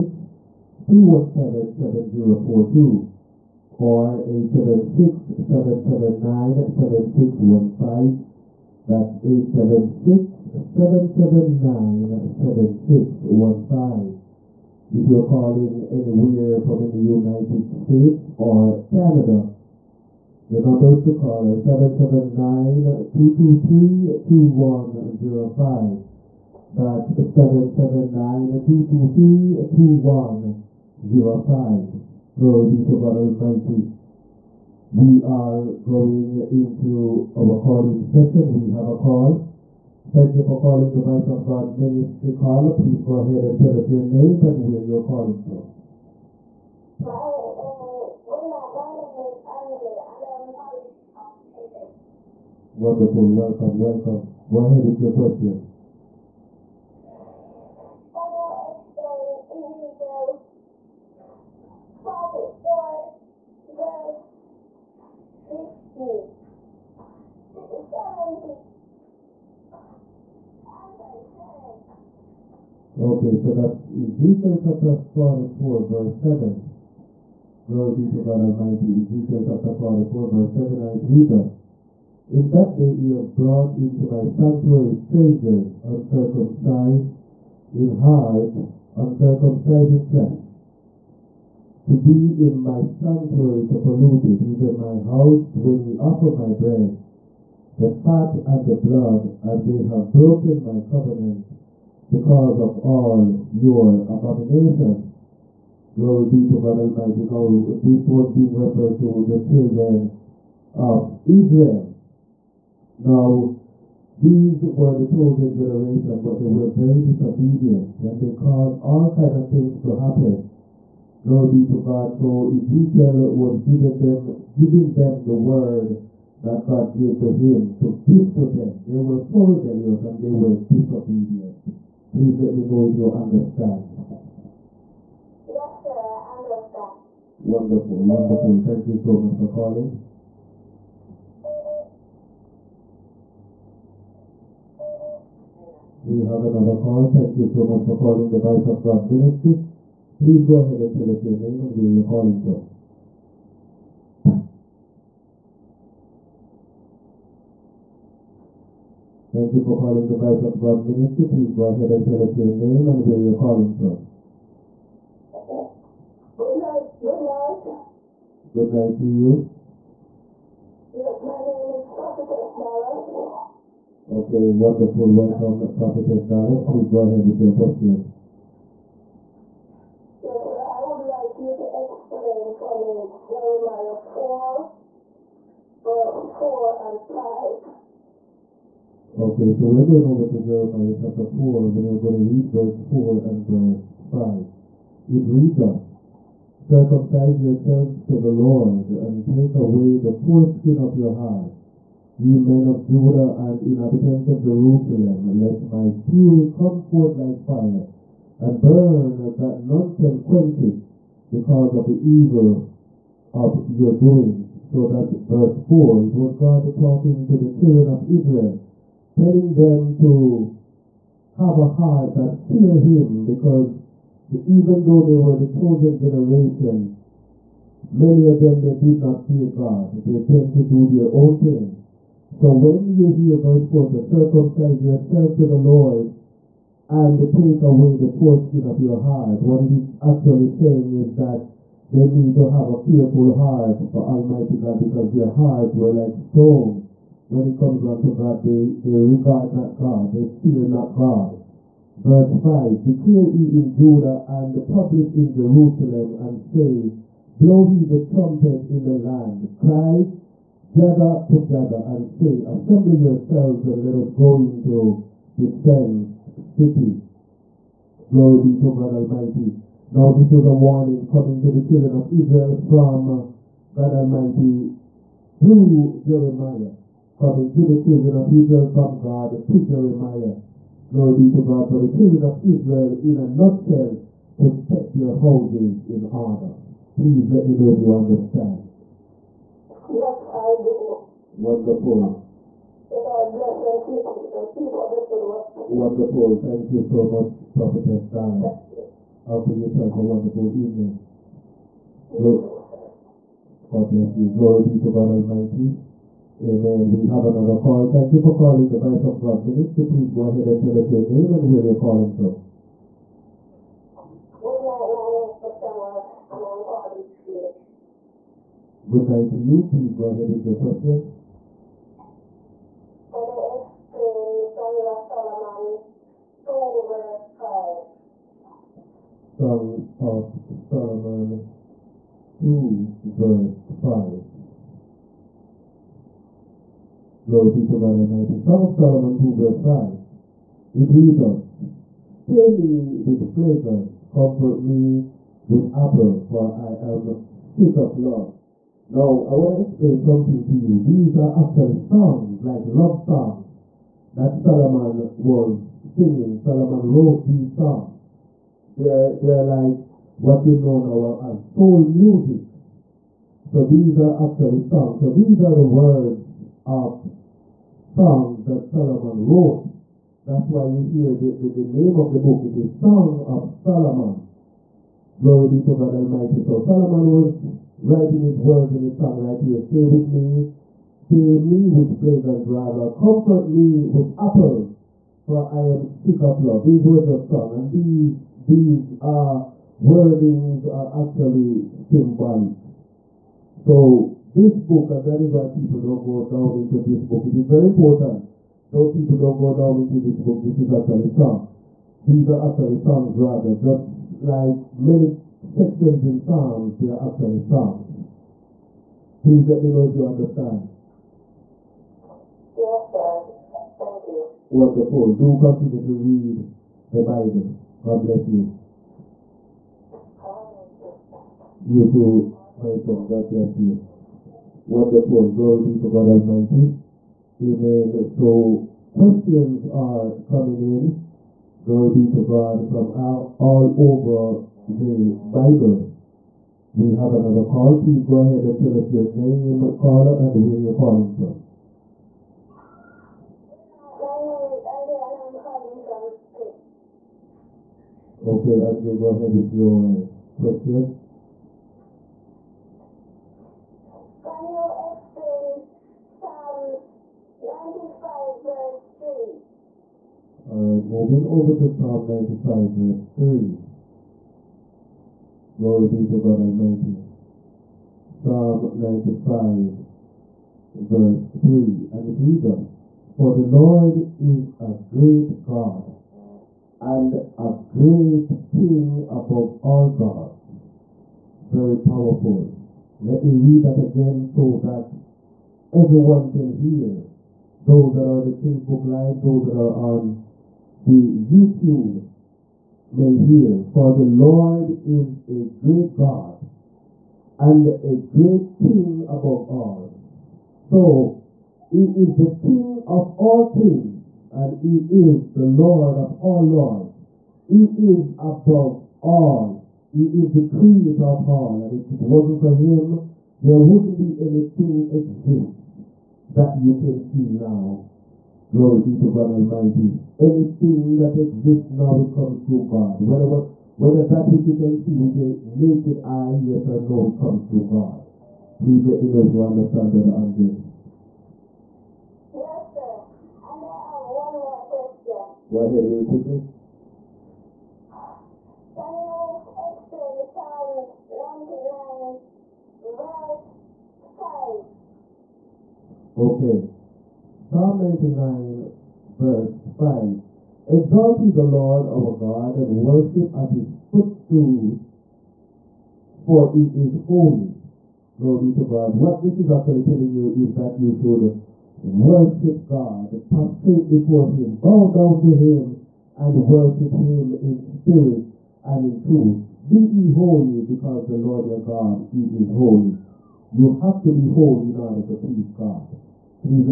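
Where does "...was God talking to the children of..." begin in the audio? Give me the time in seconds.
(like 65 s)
216 s.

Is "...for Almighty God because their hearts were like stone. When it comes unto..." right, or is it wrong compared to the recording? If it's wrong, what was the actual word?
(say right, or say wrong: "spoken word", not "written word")
right.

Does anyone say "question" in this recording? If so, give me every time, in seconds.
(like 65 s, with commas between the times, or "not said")
55 s, 177 s, 320 s, 428 s, 450 s, 534 s.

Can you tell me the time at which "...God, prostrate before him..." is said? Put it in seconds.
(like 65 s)
562 s.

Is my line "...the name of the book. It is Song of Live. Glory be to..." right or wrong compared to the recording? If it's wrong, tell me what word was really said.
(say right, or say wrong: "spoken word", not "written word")
wrong: "Solomon", not "Live".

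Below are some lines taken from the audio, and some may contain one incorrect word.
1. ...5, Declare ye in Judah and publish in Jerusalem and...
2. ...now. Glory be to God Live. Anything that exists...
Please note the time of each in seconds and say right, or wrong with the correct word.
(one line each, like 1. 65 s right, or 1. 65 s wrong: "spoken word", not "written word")
1. 252 s right
2. 517 s wrong: "Almighty", not "Live".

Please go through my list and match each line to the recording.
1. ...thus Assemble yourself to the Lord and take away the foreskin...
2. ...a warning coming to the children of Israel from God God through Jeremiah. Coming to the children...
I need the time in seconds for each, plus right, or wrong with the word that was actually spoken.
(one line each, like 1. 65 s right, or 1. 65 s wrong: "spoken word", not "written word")
1. 195 s wrong: "Circumcise", not "Assemble"
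2. 270 s wrong: "Almighty", not "God".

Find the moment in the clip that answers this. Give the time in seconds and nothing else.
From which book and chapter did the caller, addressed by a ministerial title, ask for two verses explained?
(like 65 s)
183 s.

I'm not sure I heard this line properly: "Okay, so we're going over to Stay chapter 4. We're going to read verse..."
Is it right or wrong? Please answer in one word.
wrong.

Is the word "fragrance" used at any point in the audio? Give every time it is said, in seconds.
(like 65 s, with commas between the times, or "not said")
343 s.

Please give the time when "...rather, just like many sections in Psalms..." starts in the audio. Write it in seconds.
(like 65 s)
403 s.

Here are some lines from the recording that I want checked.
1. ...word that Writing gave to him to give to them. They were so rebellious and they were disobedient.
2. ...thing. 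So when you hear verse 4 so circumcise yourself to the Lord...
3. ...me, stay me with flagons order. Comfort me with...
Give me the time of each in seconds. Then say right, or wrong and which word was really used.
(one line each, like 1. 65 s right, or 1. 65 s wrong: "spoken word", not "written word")
1. 125 s wrong: "God", not "Writing"
2. 231 s right
3. 380 s wrong: "rather", not "order".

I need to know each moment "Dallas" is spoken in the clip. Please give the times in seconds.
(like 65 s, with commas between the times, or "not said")
176 s, 298 s.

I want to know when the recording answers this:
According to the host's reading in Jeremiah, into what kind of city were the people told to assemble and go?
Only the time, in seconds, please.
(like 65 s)
265 s.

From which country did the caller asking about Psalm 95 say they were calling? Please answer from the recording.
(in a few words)
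Greece.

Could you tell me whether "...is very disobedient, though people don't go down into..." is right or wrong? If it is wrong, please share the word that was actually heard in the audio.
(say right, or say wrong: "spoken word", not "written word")
wrong: "important", not "disobedient".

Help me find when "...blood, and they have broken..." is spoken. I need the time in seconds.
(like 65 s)
98 s.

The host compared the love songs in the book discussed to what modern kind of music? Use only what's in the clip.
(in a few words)
soul music.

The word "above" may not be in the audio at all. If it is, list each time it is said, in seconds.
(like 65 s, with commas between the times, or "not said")
479 s, 499 s, 508 s.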